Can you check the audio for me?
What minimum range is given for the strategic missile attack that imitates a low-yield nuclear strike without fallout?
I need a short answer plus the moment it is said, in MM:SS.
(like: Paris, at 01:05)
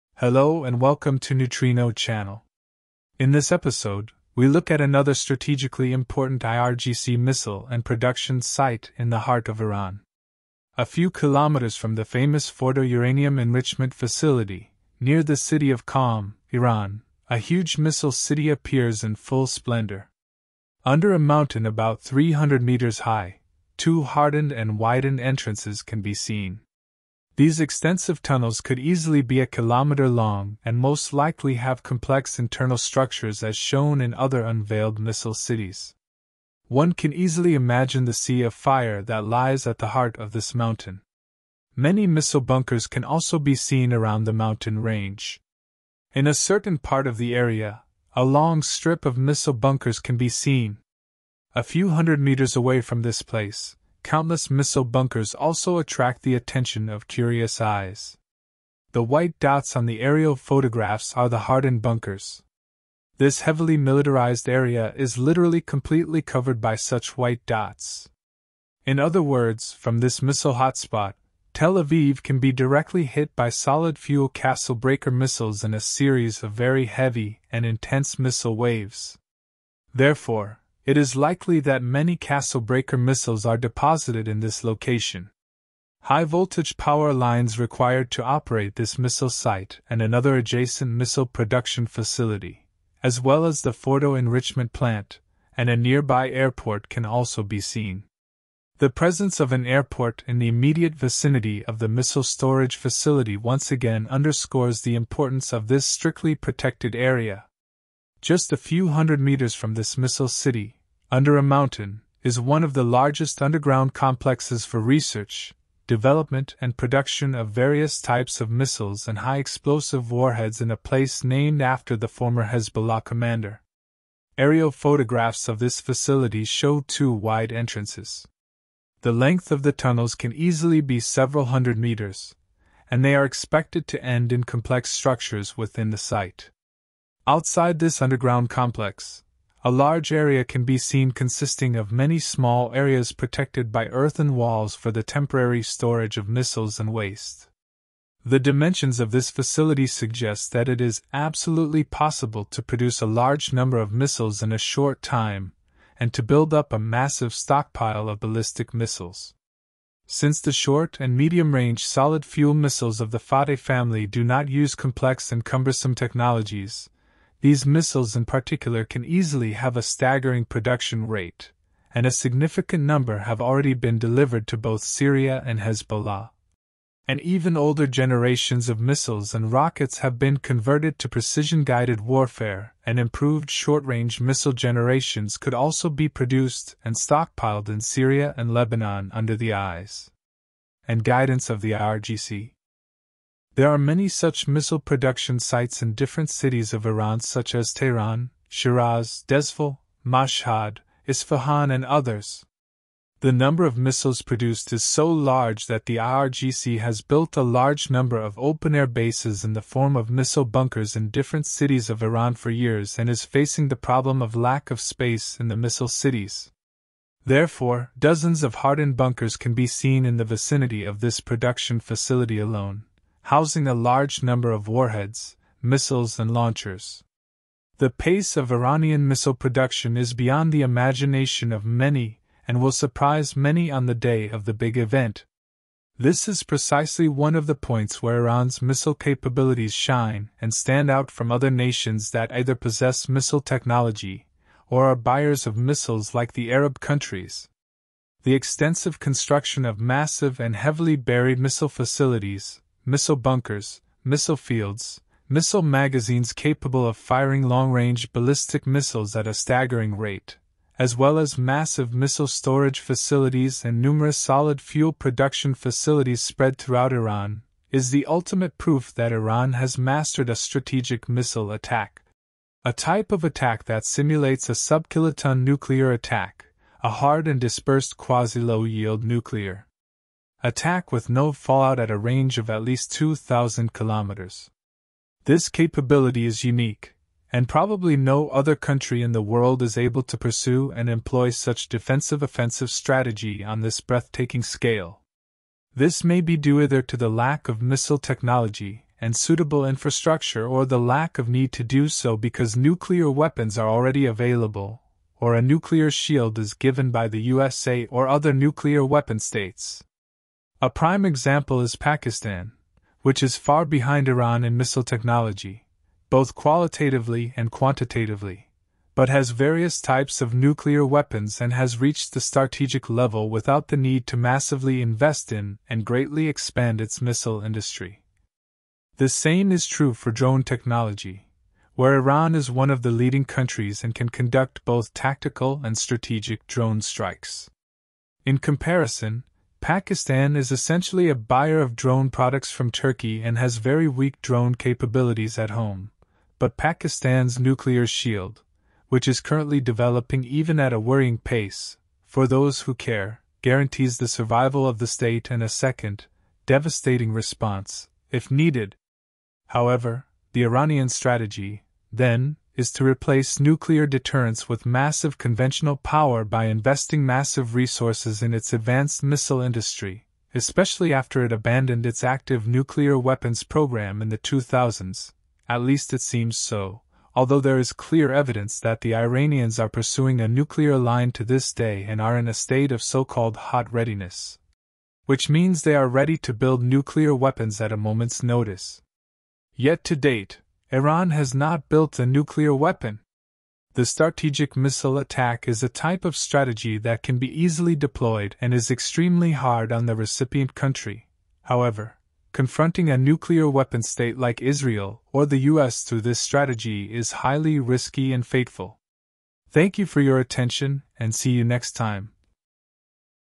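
2,000 kilometers, at 04:42.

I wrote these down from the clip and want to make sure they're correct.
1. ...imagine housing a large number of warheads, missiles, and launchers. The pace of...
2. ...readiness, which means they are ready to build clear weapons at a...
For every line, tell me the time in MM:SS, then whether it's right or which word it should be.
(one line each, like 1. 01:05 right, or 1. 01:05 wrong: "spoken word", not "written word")
1. 03:42 wrong: "alone", not "imagine"
2. 06:23 wrong: "nuclear", not "clear".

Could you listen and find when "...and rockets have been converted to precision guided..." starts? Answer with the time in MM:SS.
02:59.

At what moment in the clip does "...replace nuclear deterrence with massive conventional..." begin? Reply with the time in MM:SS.
06:02.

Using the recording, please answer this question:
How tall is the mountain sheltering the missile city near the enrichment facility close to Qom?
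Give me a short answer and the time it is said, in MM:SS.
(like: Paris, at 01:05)
300 meters, at 00:21.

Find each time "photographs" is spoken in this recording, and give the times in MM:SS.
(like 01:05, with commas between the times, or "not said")
01:00, 02:04.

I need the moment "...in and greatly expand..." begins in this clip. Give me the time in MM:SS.
05:25.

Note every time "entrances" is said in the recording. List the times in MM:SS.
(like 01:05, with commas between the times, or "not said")
00:25, 02:07.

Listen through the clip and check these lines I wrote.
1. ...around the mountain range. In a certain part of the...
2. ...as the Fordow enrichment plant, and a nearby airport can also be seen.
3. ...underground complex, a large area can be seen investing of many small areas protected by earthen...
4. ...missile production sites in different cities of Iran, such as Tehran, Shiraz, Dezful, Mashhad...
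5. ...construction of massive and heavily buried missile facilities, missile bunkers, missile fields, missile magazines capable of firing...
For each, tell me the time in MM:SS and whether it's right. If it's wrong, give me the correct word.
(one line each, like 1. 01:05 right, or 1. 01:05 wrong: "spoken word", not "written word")
1. 00:43 right
2. 01:33 right
3. 02:18 wrong: "consisting", not "investing"
4. 03:14 right
5. 04:08 right.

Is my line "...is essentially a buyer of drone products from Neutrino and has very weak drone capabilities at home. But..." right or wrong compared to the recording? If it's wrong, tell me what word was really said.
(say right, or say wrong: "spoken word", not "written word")
wrong: "Turkey", not "Neutrino".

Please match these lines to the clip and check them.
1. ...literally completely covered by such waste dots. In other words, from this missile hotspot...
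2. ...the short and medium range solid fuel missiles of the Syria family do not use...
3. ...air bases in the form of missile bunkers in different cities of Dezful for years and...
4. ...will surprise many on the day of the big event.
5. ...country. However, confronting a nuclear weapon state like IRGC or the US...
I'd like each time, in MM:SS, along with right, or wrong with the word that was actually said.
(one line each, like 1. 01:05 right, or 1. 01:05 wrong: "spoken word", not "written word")
1. 01:05 wrong: "white", not "waste"
2. 02:40 wrong: "Fateh", not "Syria"
3. 03:28 wrong: "Iran", not "Dezful"
4. 03:52 right
5. 06:40 wrong: "Israel", not "IRGC".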